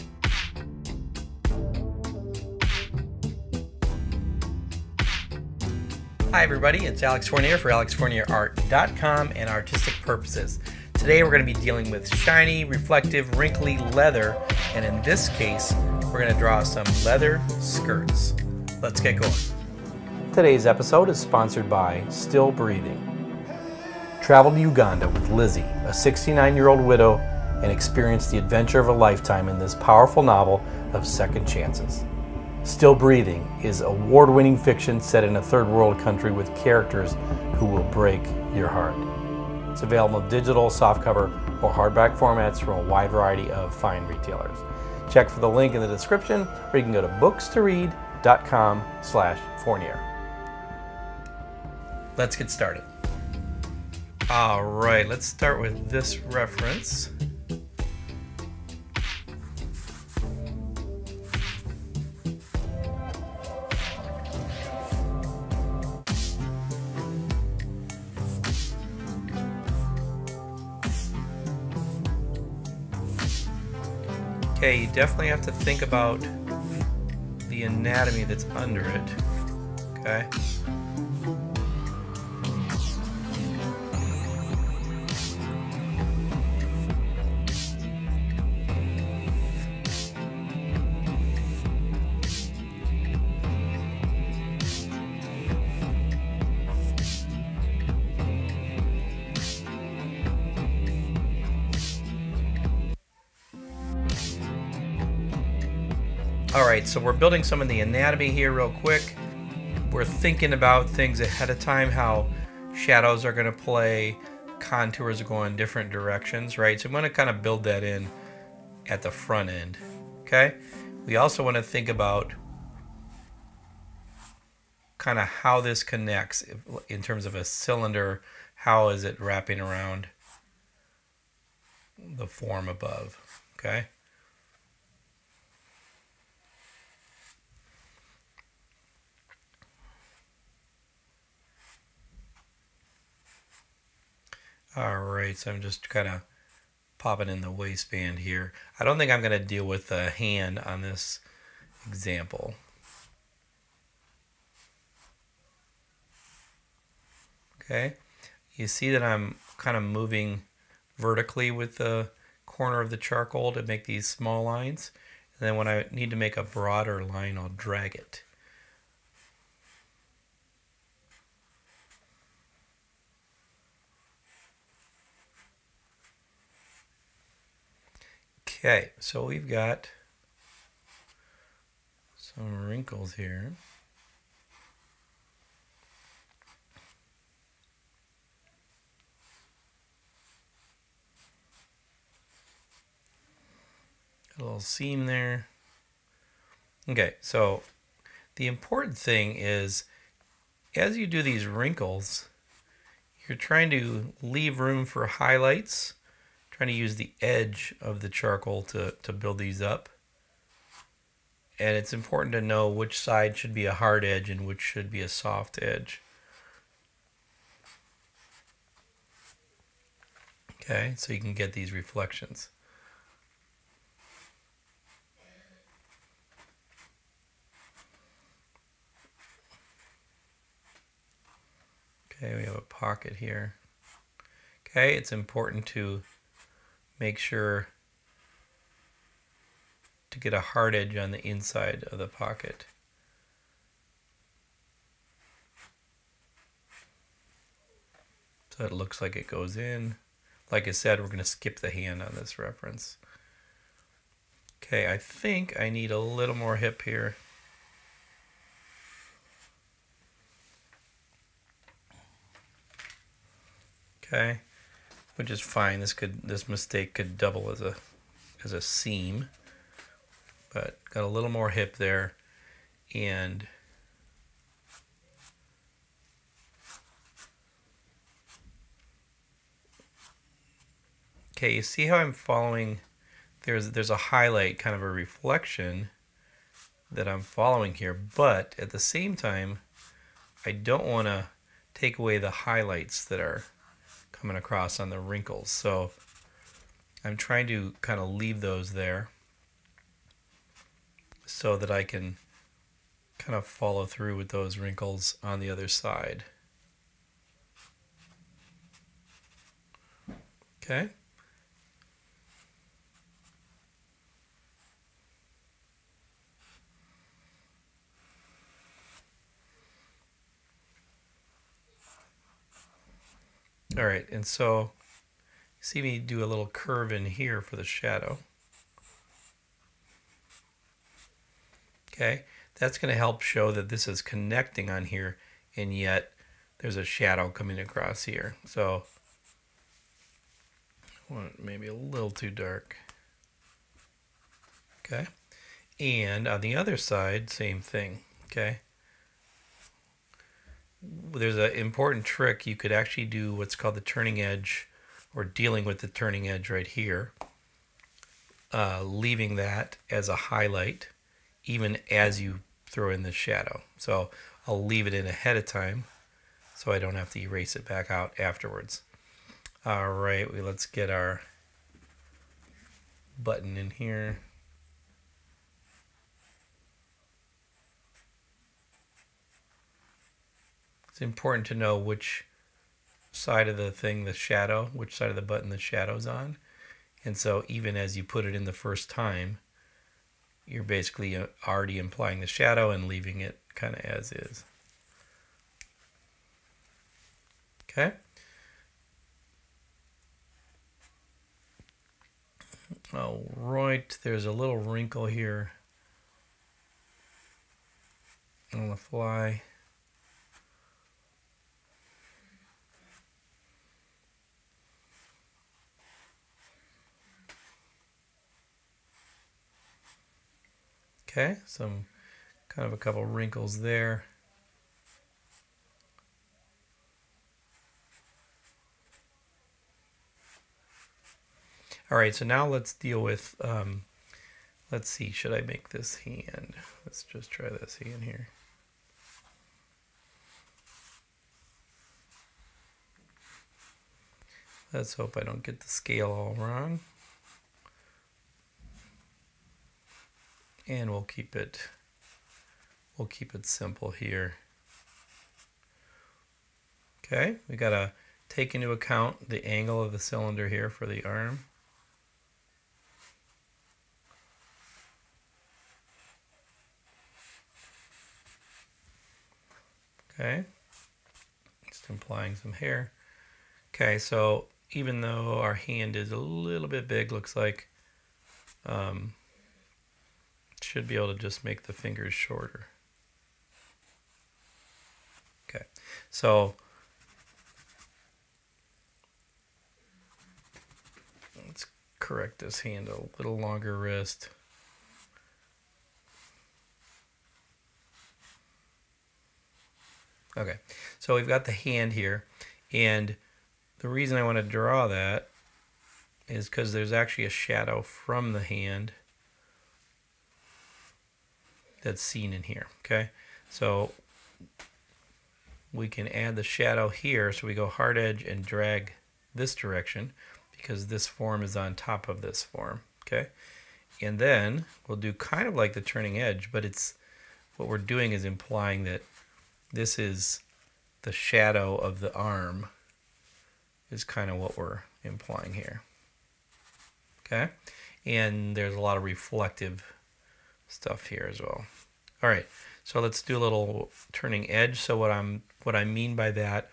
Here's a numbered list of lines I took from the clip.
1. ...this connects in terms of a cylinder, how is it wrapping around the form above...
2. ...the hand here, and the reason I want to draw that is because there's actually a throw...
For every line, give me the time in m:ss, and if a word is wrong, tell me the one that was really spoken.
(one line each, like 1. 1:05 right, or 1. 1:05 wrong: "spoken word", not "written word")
1. 2:05 right
2. 8:21 wrong: "shadow", not "throw".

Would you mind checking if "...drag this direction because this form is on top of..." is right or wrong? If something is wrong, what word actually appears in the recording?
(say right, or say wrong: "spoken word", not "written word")
right.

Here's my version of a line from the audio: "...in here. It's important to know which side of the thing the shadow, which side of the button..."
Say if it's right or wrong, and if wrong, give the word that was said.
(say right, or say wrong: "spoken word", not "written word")
right.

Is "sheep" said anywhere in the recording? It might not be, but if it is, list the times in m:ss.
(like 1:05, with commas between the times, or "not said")
not said.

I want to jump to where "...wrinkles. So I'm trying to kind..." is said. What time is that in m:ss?
4:54.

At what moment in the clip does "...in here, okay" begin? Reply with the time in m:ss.
8:32.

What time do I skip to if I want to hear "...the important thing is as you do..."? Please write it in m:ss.
3:18.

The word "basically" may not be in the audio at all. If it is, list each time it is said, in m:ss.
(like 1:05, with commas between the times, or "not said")
6:30.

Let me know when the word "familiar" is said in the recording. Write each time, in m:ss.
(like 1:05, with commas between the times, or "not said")
not said.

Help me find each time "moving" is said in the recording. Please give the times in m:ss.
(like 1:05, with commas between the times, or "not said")
2:39.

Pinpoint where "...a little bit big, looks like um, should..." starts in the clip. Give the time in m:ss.
7:56.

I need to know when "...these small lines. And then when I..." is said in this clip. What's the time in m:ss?
2:43.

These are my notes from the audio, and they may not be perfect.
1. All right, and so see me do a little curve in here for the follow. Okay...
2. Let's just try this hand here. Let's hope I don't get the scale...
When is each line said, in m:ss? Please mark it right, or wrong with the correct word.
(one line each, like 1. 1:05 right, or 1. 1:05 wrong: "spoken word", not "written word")
1. 5:23 wrong: "shadow", not "follow"
2. 7:16 right.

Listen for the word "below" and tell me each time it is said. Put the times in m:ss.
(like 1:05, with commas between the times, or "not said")
not said.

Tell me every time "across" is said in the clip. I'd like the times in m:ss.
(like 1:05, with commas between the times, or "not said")
4:54, 5:37.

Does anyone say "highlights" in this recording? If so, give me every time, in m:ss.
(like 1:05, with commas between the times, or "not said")
3:25, 4:43, 4:52, 6:00.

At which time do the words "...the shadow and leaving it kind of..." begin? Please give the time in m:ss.
6:32.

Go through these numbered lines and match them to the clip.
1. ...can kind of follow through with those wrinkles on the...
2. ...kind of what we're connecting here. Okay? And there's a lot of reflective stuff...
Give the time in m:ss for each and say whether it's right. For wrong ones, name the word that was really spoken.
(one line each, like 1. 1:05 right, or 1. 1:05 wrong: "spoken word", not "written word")
1. 5:01 right
2. 8:54 wrong: "implying", not "connecting".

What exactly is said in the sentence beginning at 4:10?
Like I said, we're going to skip the hand on this reference.